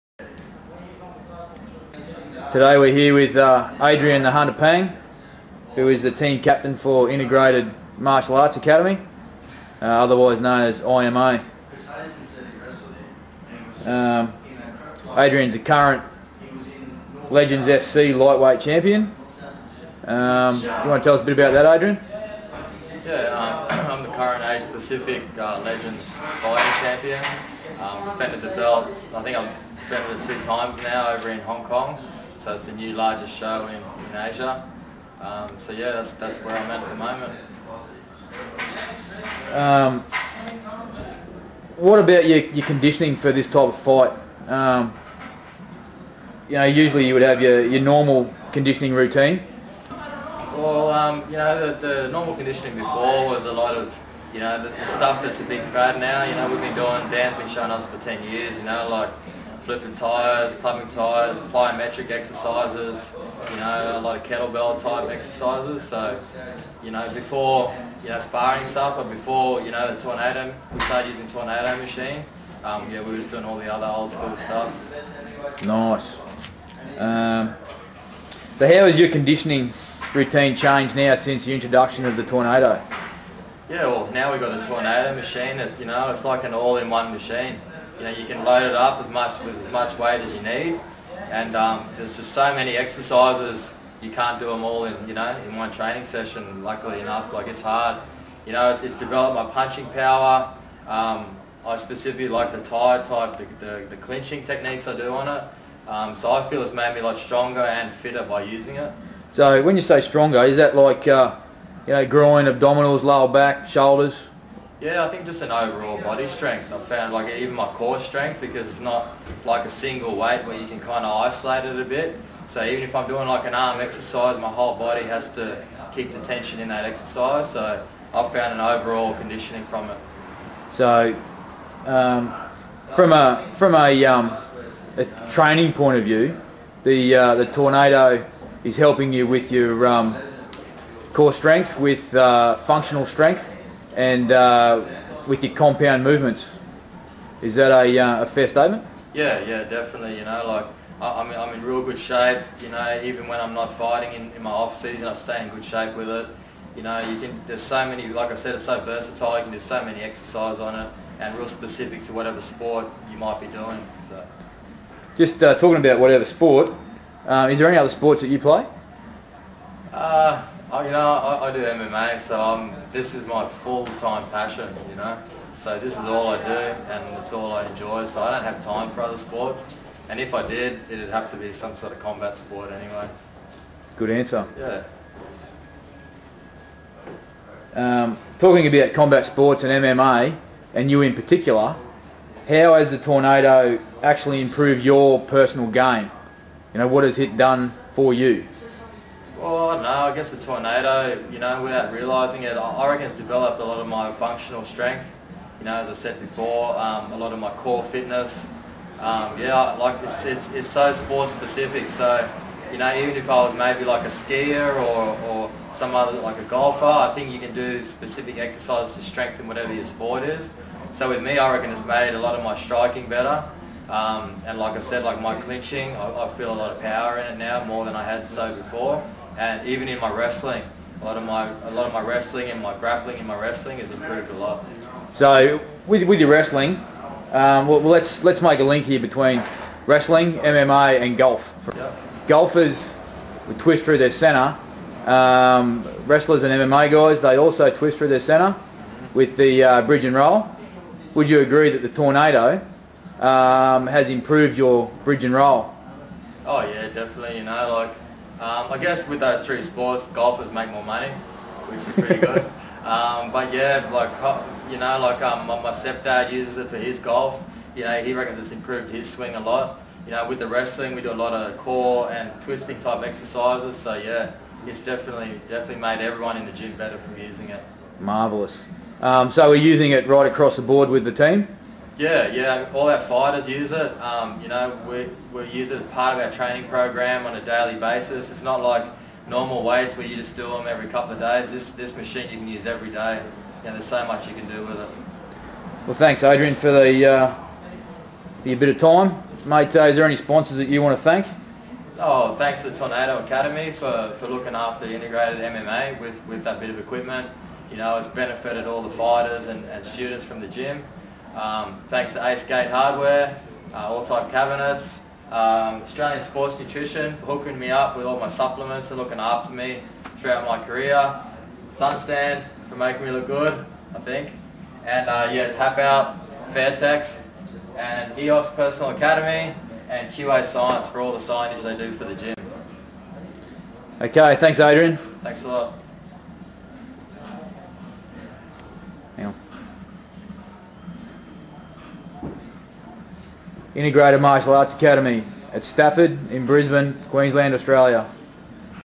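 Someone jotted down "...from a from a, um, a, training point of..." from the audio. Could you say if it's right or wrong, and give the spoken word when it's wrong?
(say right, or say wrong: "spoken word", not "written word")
right.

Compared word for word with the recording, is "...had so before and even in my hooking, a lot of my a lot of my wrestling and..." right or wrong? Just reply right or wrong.
wrong.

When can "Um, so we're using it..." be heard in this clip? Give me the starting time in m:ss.
4:39.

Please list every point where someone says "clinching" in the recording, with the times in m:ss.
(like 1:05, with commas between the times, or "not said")
1:43, 3:45.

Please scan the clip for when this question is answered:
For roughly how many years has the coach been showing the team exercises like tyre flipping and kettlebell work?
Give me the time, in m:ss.
0:57.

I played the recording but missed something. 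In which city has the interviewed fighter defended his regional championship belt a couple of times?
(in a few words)
Hong Kong.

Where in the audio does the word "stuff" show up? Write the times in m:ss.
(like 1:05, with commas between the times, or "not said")
0:54, 1:08, 1:14.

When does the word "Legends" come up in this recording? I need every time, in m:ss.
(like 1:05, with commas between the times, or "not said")
0:17, 0:25.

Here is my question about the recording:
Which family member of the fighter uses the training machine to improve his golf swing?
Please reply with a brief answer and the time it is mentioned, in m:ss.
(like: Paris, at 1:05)
stepdad, at 4:25.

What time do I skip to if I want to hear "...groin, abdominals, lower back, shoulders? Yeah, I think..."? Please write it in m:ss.
1:52.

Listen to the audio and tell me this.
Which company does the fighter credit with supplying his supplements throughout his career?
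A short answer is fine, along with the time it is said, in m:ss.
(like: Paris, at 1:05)
Australian Sports Nutrition, at 5:15.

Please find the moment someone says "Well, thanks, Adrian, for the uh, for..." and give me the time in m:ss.
4:55.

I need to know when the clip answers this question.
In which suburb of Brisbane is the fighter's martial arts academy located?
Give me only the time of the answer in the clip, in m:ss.
5:45.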